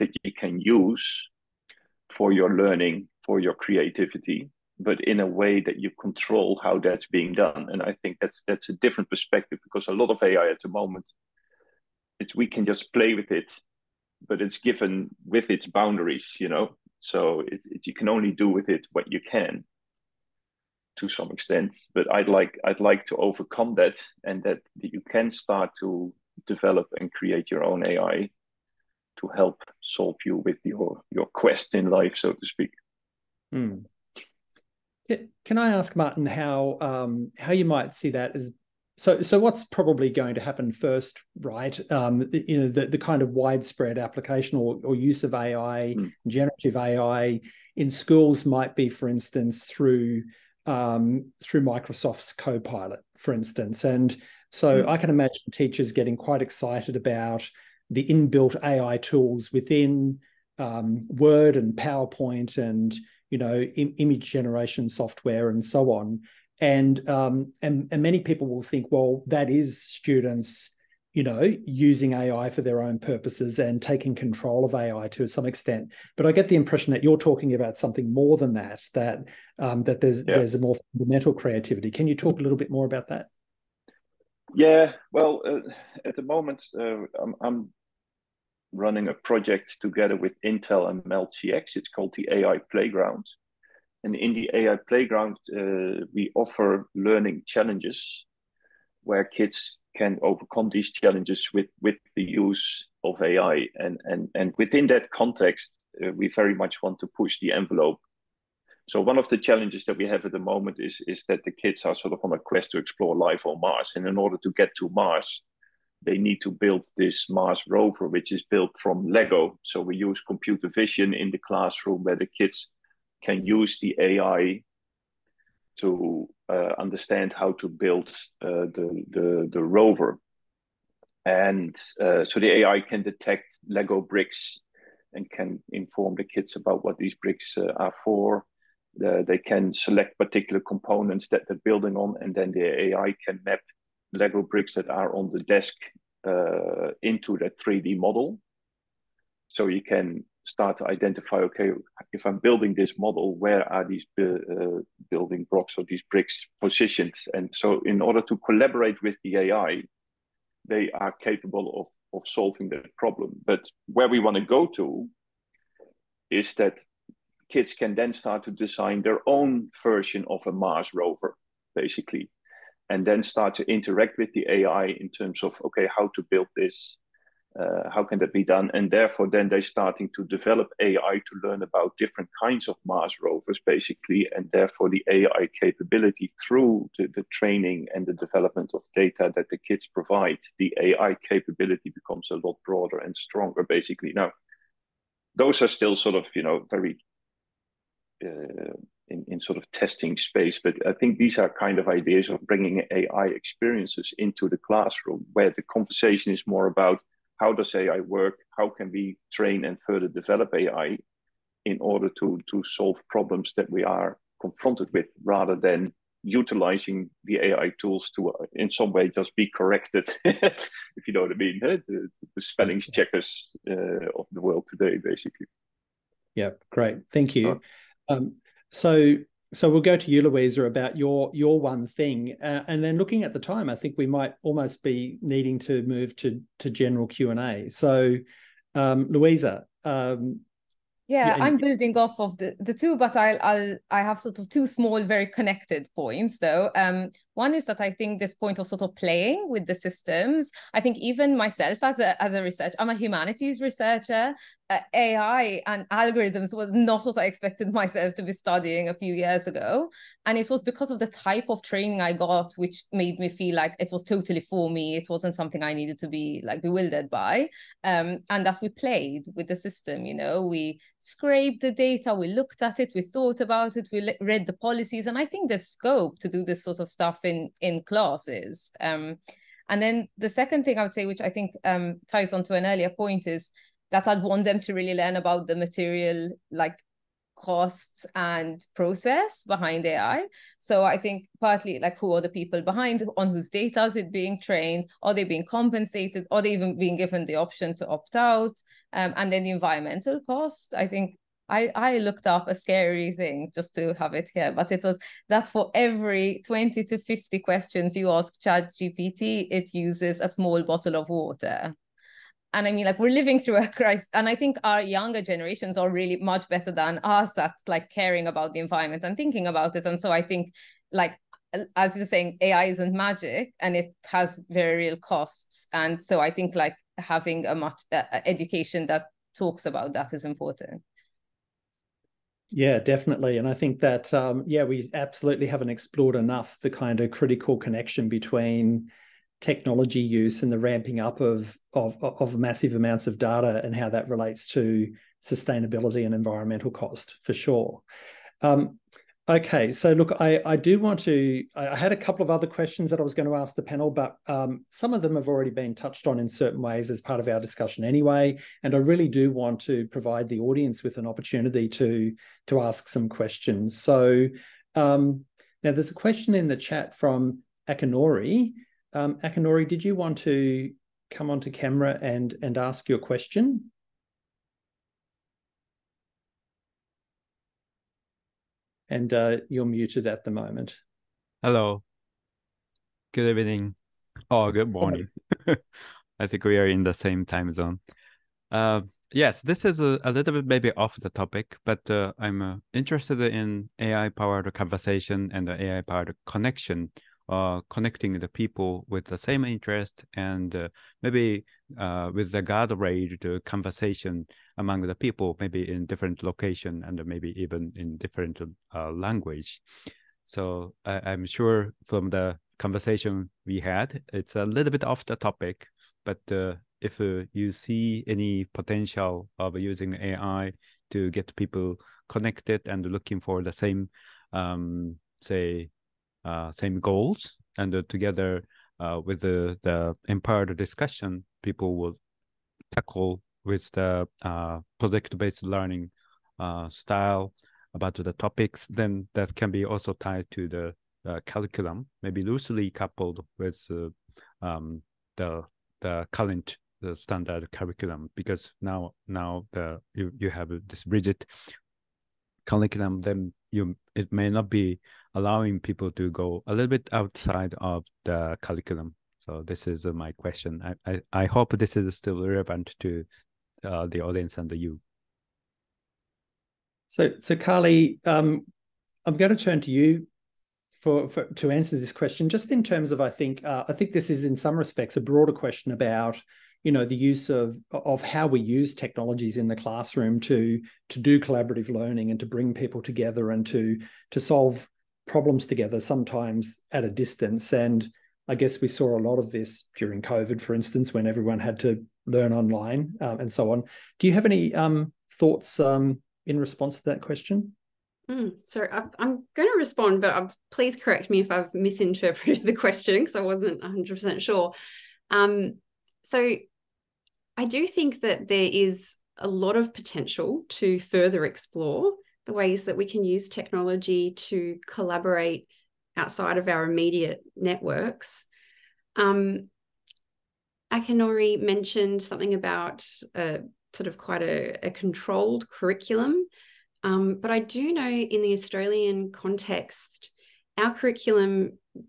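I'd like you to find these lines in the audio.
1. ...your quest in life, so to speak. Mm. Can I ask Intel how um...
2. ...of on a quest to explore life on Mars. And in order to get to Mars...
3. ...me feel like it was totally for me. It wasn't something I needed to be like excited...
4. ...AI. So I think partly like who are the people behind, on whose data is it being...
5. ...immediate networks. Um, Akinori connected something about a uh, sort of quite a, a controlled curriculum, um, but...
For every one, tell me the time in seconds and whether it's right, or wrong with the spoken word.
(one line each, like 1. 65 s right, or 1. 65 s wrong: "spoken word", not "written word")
1. 31 s wrong: "Maarten", not "Intel"
2. 112 s right
3. 263 s wrong: "bewildered", not "excited"
4. 289 s right
5. 516 s wrong: "mentioned", not "connected".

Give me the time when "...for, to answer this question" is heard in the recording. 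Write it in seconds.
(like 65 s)
471 s.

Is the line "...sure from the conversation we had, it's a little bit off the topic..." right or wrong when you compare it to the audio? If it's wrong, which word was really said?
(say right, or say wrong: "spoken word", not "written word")
right.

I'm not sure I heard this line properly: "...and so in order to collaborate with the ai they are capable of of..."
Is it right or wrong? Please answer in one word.
right.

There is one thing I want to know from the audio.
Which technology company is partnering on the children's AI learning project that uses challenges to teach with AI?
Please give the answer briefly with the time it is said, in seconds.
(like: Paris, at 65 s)
Intel, at 90 s.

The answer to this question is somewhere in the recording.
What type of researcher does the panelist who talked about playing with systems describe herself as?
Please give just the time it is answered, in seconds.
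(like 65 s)
252 s.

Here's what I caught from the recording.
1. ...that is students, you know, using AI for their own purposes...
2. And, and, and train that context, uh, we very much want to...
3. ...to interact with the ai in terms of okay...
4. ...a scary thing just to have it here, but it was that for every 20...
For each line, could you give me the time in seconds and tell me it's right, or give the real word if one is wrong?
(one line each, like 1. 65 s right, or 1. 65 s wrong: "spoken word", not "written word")
1. 69 s right
2. 103 s wrong: "within", not "train"
3. 173 s right
4. 302 s right.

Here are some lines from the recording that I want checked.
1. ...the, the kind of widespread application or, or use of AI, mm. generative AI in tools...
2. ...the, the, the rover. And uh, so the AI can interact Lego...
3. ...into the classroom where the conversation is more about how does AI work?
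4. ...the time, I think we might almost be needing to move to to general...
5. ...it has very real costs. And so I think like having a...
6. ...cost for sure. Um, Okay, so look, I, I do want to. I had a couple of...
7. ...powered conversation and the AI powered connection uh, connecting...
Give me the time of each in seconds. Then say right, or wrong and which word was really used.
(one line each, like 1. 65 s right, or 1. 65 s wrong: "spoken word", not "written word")
1. 42 s wrong: "schools", not "tools"
2. 128 s wrong: "detect", not "interact"
3. 204 s right
4. 233 s right
5. 323 s right
6. 346 s right
7. 394 s right.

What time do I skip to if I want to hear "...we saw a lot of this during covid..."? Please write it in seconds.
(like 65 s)
488 s.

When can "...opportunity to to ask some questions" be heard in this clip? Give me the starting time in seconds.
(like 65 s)
361 s.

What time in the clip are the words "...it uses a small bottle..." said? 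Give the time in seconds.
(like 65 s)
309 s.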